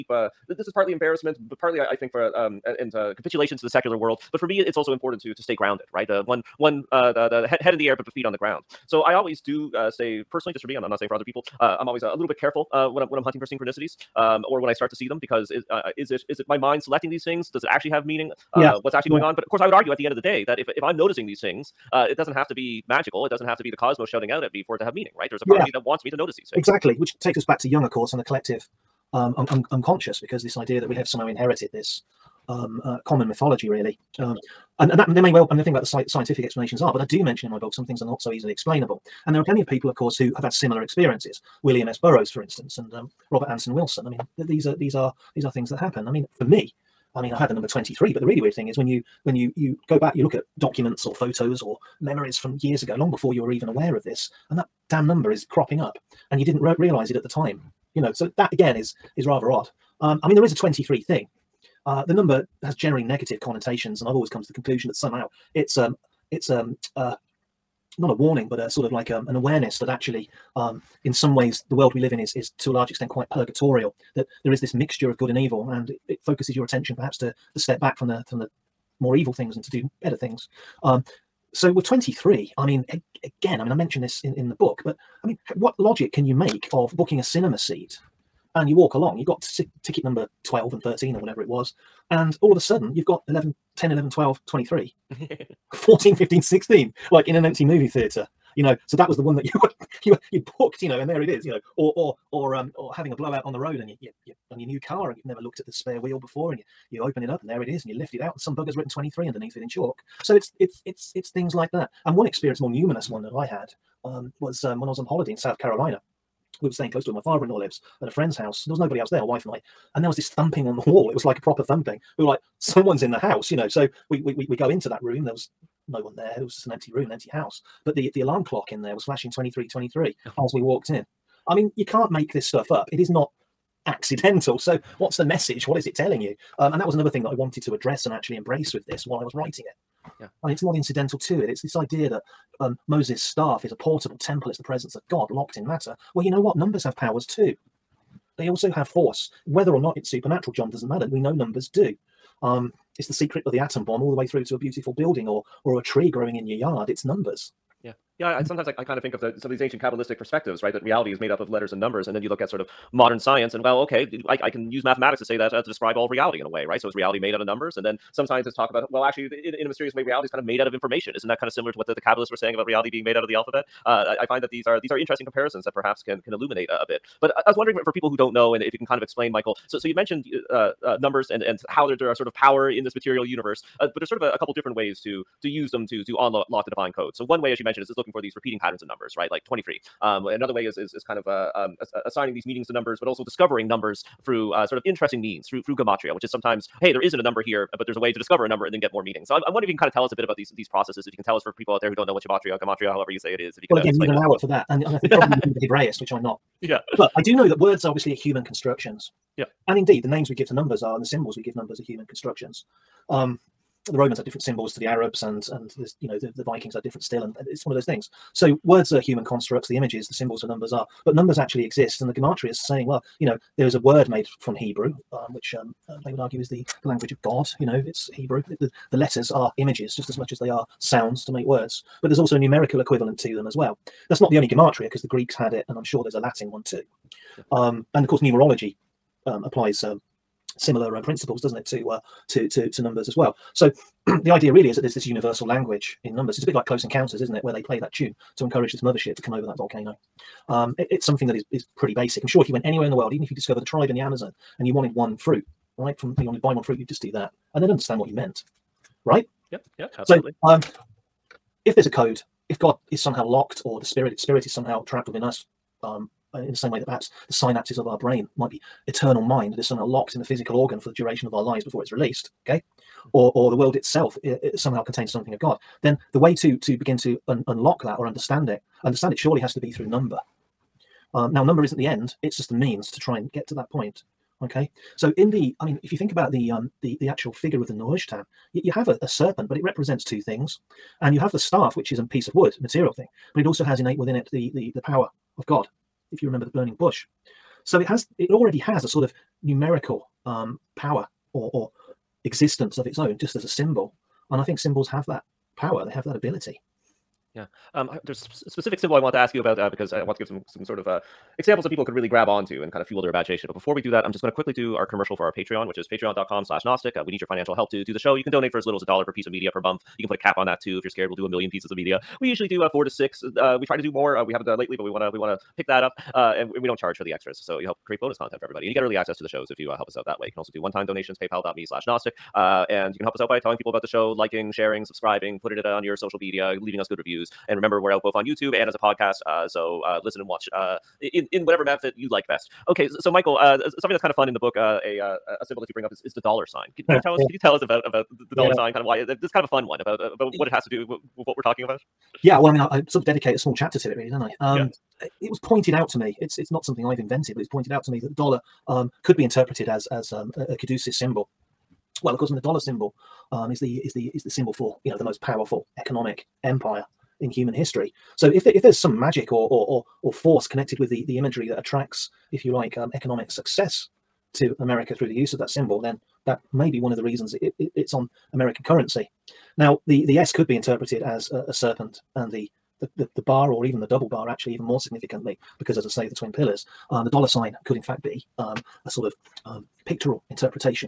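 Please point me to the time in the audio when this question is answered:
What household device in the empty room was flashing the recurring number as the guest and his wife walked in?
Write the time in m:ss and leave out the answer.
2:08.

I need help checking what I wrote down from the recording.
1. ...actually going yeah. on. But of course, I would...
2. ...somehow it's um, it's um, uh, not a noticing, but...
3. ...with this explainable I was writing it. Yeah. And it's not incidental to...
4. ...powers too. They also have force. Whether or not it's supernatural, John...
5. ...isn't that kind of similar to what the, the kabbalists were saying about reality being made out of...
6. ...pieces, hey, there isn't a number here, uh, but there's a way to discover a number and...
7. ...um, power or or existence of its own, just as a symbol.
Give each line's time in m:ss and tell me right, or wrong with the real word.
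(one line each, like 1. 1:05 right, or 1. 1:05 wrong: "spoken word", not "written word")
1. 0:18 right
2. 1:04 wrong: "warning", not "noticing"
3. 2:18 wrong: "while", not "explainable"
4. 2:26 right
5. 2:51 right
6. 3:16 wrong: "sometimes", not "pieces"
7. 5:00 right.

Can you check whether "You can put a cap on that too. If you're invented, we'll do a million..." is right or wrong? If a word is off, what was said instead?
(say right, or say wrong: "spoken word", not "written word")
wrong: "scared", not "invented".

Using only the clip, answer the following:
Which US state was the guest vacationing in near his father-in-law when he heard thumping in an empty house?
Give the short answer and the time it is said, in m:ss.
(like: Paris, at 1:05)
South Carolina, at 1:55.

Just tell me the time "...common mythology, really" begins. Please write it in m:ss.
0:33.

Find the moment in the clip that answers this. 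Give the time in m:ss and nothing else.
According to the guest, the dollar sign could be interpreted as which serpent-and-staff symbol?
6:00.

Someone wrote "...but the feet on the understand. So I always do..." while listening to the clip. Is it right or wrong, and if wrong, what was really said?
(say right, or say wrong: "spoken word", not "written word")
wrong: "ground", not "understand".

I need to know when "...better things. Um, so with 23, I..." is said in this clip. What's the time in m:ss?
1:20.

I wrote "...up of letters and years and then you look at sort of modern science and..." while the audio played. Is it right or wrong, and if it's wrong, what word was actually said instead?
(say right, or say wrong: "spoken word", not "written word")
wrong: "numbers", not "years".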